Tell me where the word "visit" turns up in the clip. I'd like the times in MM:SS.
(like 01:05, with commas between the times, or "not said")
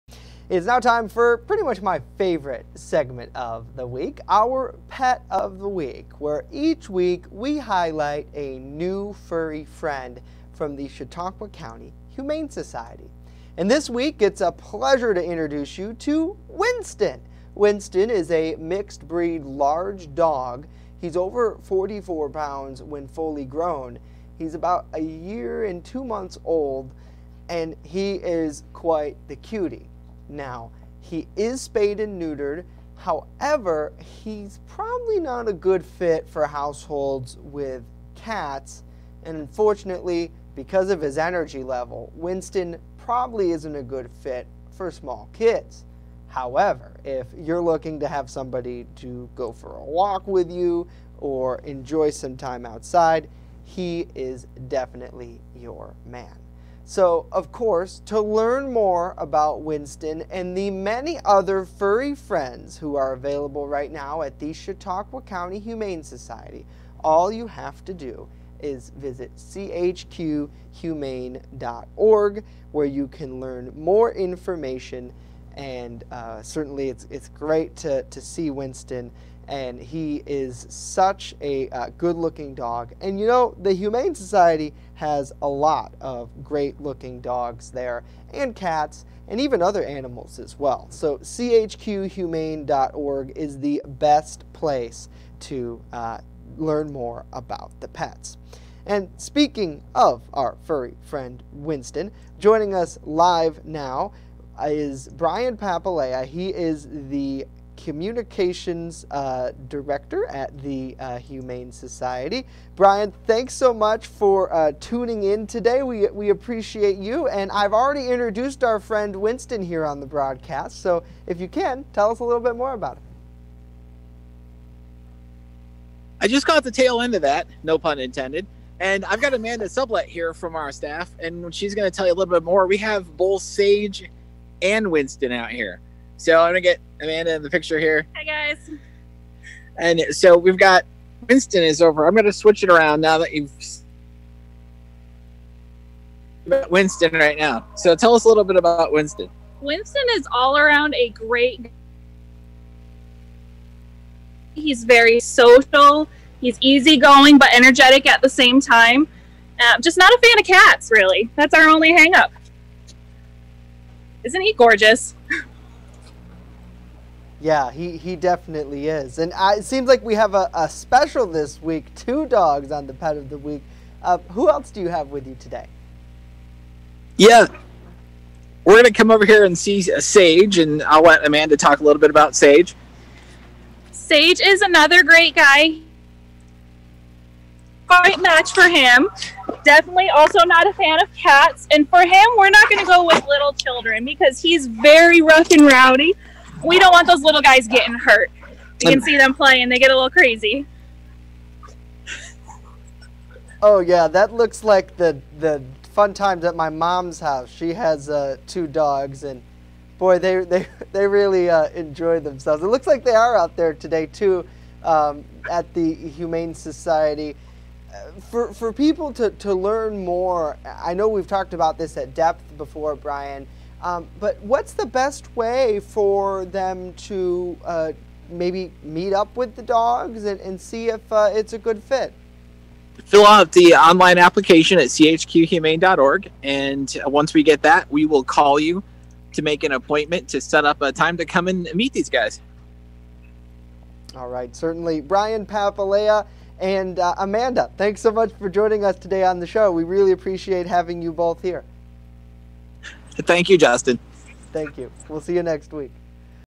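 01:08.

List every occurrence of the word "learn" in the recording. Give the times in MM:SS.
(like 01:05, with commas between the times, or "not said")
00:58, 01:13, 01:36, 03:39.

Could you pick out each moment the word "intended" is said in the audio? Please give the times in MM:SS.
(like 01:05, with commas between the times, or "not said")
02:07.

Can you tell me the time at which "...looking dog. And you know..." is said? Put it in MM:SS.
01:22.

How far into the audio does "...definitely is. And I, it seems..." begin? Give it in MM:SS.
02:48.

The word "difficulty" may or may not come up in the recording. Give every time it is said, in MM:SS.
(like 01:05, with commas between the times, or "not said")
not said.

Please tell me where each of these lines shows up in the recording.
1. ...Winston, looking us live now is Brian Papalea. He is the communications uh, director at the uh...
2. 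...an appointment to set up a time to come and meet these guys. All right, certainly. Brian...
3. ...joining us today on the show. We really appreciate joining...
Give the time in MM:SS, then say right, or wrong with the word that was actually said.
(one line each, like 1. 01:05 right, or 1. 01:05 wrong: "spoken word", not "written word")
1. 01:41 wrong: "joining", not "looking"
2. 03:59 right
3. 04:08 wrong: "having", not "joining".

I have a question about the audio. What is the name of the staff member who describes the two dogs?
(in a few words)
Amanda Sublet.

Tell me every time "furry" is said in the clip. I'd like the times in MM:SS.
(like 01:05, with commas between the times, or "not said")
00:09, 01:01, 01:40.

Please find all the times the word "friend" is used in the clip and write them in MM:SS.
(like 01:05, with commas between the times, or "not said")
00:09, 01:02, 01:41, 01:58.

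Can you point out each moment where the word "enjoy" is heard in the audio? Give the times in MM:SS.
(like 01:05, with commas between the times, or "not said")
00:51, 03:31.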